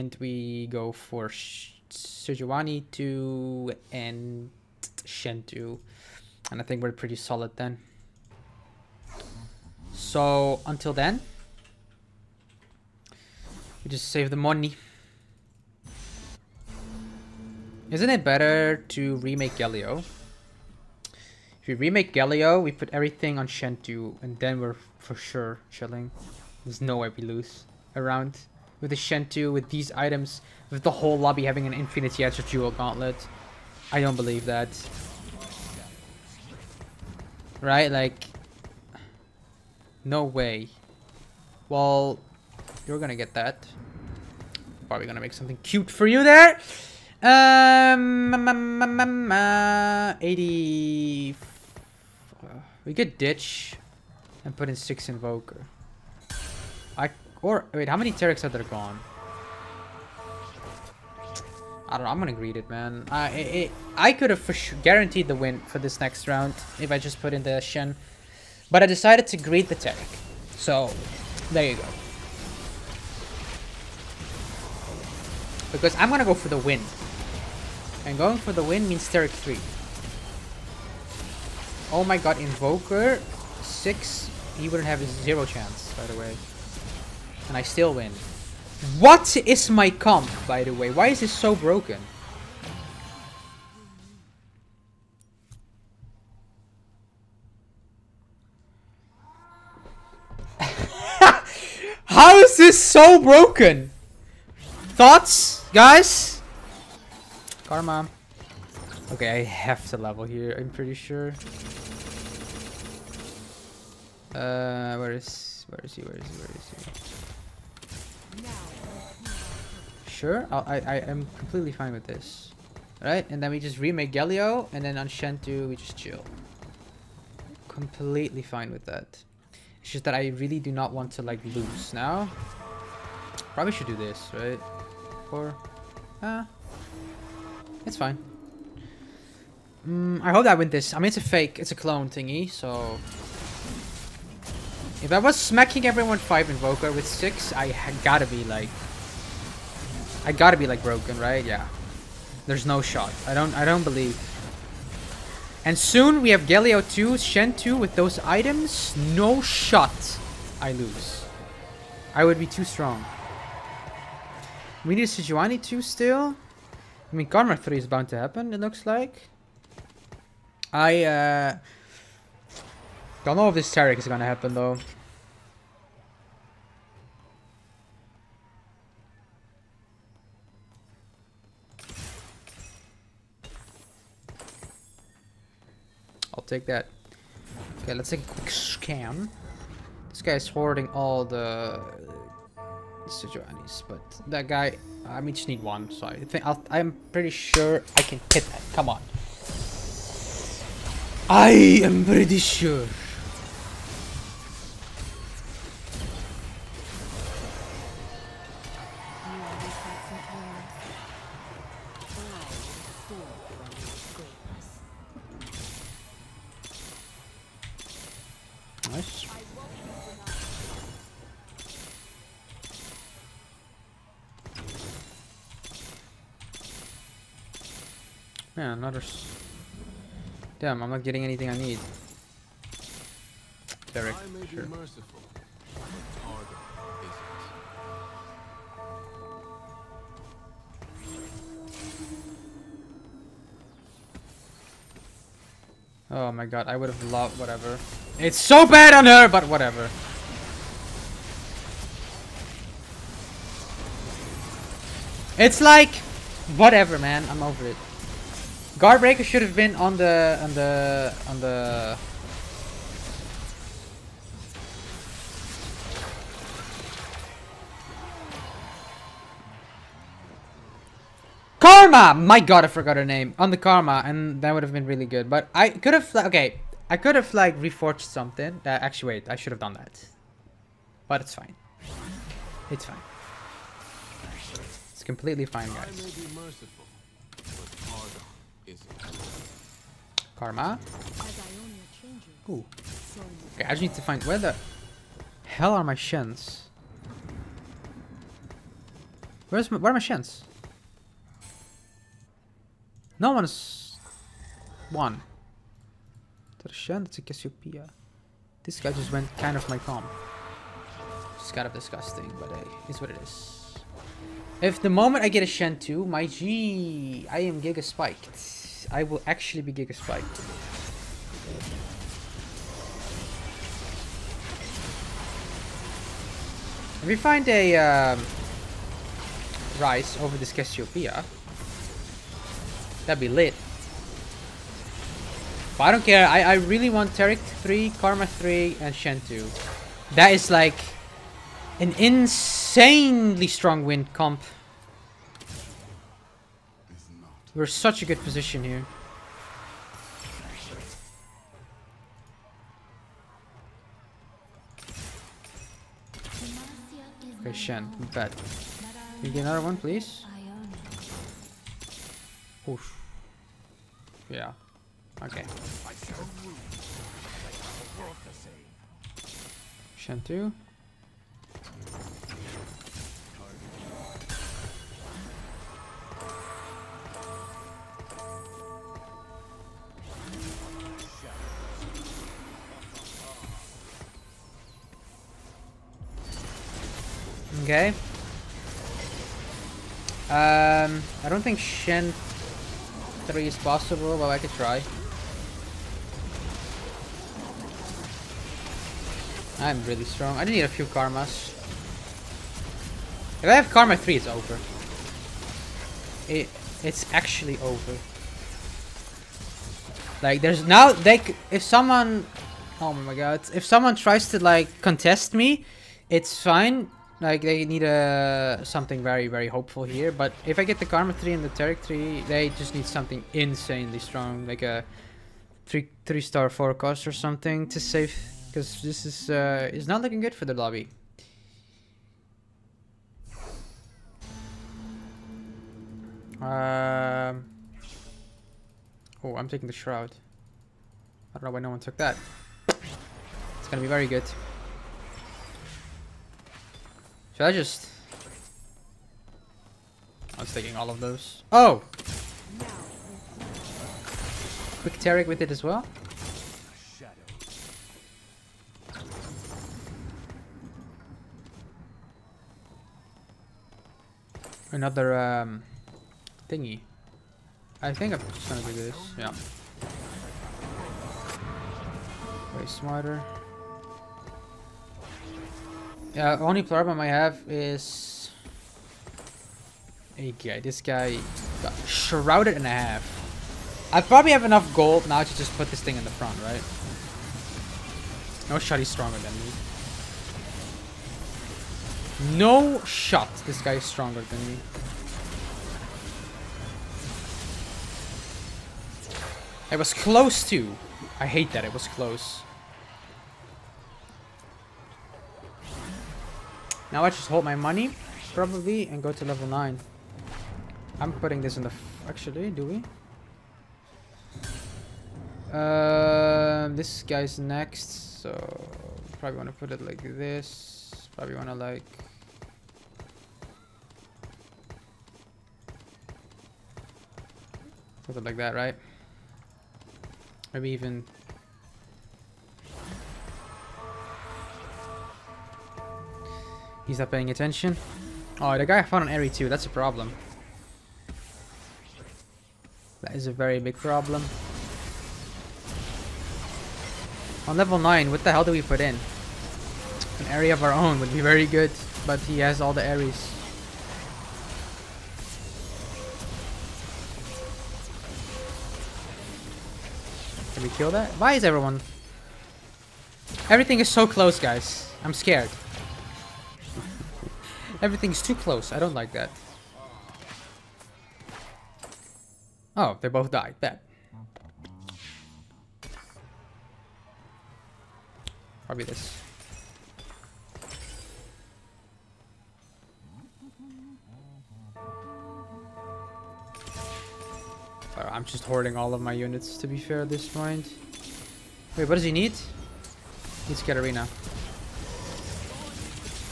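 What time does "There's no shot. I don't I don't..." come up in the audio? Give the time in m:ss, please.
2:32.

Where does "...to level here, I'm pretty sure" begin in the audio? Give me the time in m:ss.
1:49.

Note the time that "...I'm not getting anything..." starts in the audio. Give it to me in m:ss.
3:50.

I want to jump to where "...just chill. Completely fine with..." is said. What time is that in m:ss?
2:05.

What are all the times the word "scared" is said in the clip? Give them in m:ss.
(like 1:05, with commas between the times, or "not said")
9:25.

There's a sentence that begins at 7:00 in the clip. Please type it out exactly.
But if I get the Karma 3 and the Taric 3, they just need something insanely strong.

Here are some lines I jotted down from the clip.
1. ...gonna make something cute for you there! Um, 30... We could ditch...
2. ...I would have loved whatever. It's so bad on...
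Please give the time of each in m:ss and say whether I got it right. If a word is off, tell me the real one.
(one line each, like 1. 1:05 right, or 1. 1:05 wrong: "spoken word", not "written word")
1. 0:45 wrong: "80", not "30"
2. 4:06 right.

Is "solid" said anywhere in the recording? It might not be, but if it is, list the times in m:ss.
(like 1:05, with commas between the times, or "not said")
0:07.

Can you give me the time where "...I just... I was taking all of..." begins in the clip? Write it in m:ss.
7:27.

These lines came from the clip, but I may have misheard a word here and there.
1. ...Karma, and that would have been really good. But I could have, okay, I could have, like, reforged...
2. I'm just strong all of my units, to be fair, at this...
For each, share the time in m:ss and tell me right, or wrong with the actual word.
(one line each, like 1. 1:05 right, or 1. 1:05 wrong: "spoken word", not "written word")
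1. 4:33 right
2. 9:47 wrong: "hoarding", not "strong".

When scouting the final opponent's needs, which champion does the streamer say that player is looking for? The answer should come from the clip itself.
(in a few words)
Katarina.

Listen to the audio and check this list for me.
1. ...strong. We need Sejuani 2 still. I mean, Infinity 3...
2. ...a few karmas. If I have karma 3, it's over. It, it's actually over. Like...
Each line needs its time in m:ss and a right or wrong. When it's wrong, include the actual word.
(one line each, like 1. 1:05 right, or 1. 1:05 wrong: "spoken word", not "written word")
1. 2:42 wrong: "Karma", not "Infinity"
2. 6:40 right.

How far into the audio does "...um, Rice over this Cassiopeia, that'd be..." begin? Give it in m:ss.
5:27.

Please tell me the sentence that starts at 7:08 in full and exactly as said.
Because this is uh, is not looking good for the lobby.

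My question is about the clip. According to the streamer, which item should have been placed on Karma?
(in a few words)
Guardbreaker.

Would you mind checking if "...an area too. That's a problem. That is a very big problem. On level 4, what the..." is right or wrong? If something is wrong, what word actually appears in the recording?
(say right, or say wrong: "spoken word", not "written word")
wrong: "9", not "4".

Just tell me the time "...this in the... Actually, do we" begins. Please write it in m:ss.
8:31.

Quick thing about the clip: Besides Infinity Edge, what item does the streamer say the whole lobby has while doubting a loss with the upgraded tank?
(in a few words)
Jewel Gauntlet.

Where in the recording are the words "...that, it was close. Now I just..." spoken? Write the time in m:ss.
8:21.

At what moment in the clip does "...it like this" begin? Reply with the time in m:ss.
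8:39.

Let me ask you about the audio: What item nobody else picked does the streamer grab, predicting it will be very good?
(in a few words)
Shroud.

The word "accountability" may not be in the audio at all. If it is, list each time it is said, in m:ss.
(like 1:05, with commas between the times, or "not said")
not said.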